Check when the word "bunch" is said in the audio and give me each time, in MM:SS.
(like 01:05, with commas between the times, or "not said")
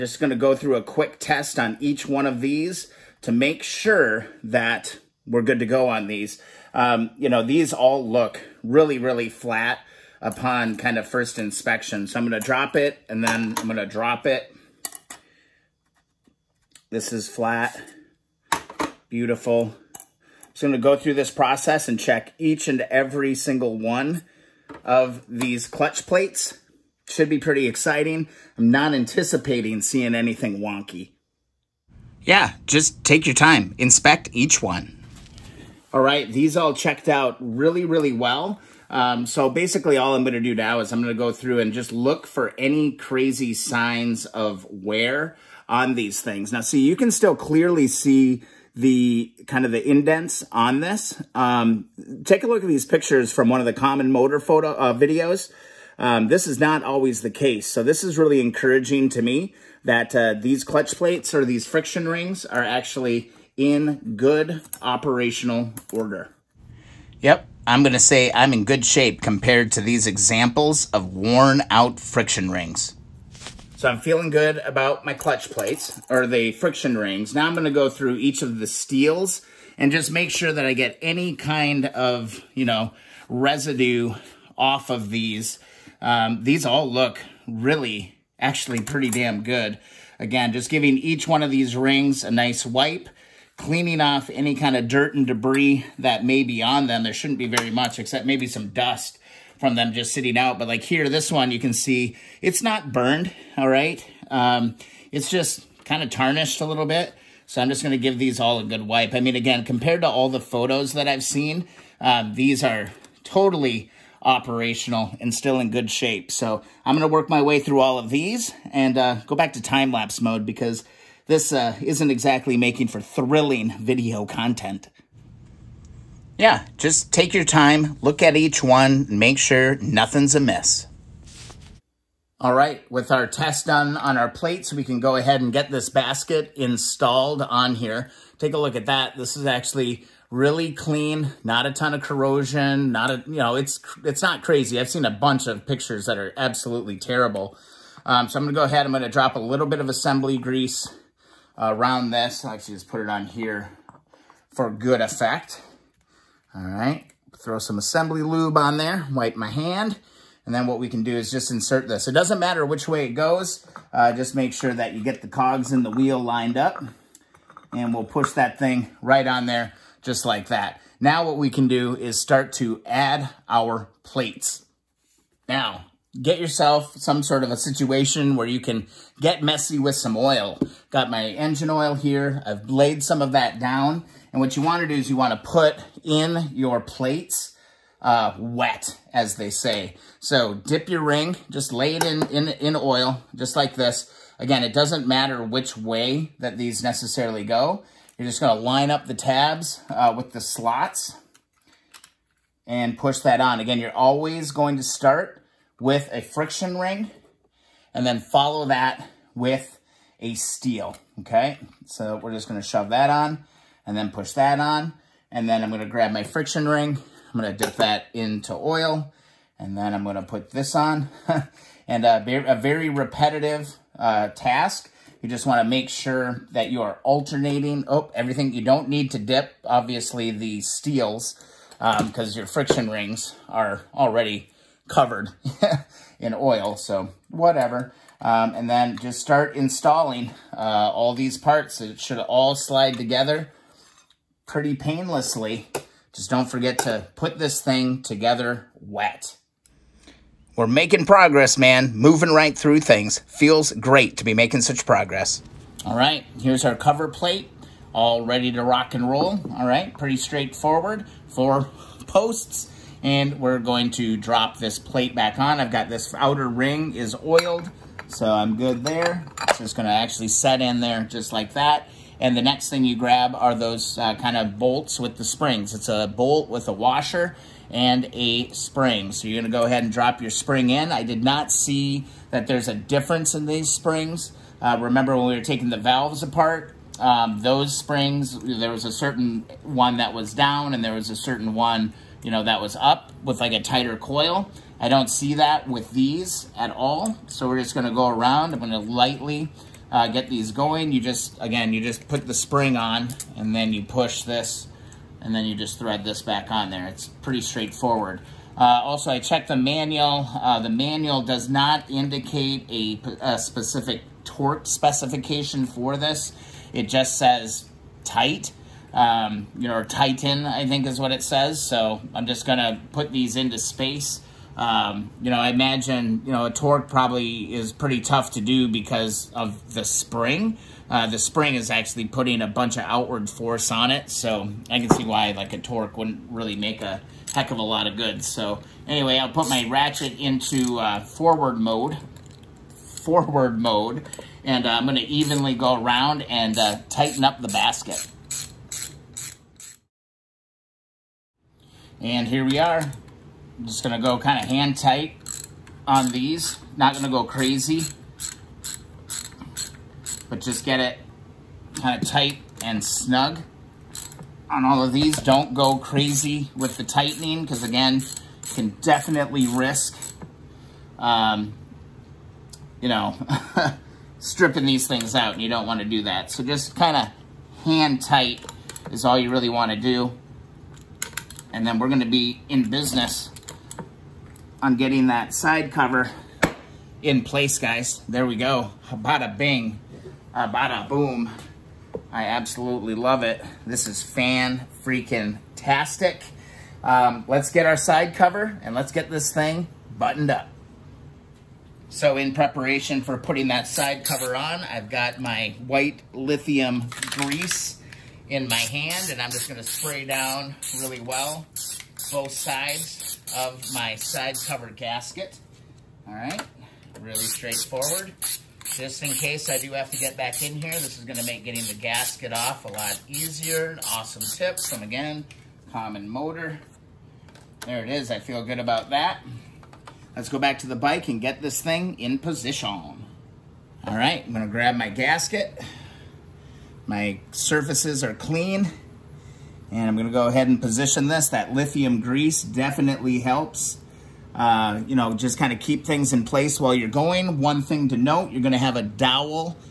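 02:25, 05:32.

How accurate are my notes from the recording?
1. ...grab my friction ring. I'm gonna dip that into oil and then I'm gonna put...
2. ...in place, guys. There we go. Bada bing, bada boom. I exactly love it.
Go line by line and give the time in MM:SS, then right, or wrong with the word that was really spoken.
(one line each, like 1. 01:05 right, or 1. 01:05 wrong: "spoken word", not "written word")
1. 03:35 right
2. 06:27 wrong: "absolutely", not "exactly".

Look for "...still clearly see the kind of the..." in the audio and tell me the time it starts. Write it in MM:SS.
00:47.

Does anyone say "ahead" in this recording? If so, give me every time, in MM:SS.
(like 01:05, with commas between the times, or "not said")
02:15, 02:28, 04:39, 07:20.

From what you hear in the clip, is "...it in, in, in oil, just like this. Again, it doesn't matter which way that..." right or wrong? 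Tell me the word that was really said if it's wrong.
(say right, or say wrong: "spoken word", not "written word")
right.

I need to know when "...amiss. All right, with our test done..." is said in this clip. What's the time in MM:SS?
02:10.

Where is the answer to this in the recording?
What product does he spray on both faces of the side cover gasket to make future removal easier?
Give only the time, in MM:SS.
06:45.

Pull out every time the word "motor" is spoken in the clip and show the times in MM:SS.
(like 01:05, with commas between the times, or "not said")
00:54, 07:06.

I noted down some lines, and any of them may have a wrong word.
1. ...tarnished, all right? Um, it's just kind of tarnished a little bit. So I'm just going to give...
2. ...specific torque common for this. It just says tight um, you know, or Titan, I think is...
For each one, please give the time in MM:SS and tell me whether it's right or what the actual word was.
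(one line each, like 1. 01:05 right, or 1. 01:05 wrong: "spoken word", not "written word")
1. 01:42 wrong: "burned", not "tarnished"
2. 05:13 wrong: "specification", not "common".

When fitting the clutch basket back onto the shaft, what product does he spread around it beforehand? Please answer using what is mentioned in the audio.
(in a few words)
assembly grease.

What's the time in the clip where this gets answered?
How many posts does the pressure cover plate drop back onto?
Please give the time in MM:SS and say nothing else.
04:21.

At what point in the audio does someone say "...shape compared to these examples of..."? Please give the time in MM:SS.
01:08.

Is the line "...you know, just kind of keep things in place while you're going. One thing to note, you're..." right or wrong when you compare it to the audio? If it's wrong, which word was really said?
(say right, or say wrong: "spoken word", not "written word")
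right.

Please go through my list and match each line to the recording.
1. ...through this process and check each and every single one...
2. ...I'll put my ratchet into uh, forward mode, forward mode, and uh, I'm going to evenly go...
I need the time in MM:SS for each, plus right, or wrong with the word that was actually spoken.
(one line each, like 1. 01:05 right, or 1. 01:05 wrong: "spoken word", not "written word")
1. 00:20 right
2. 05:39 right.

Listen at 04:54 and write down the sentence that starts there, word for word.
I don't see that with these at all.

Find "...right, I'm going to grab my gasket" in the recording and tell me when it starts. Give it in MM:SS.
07:13.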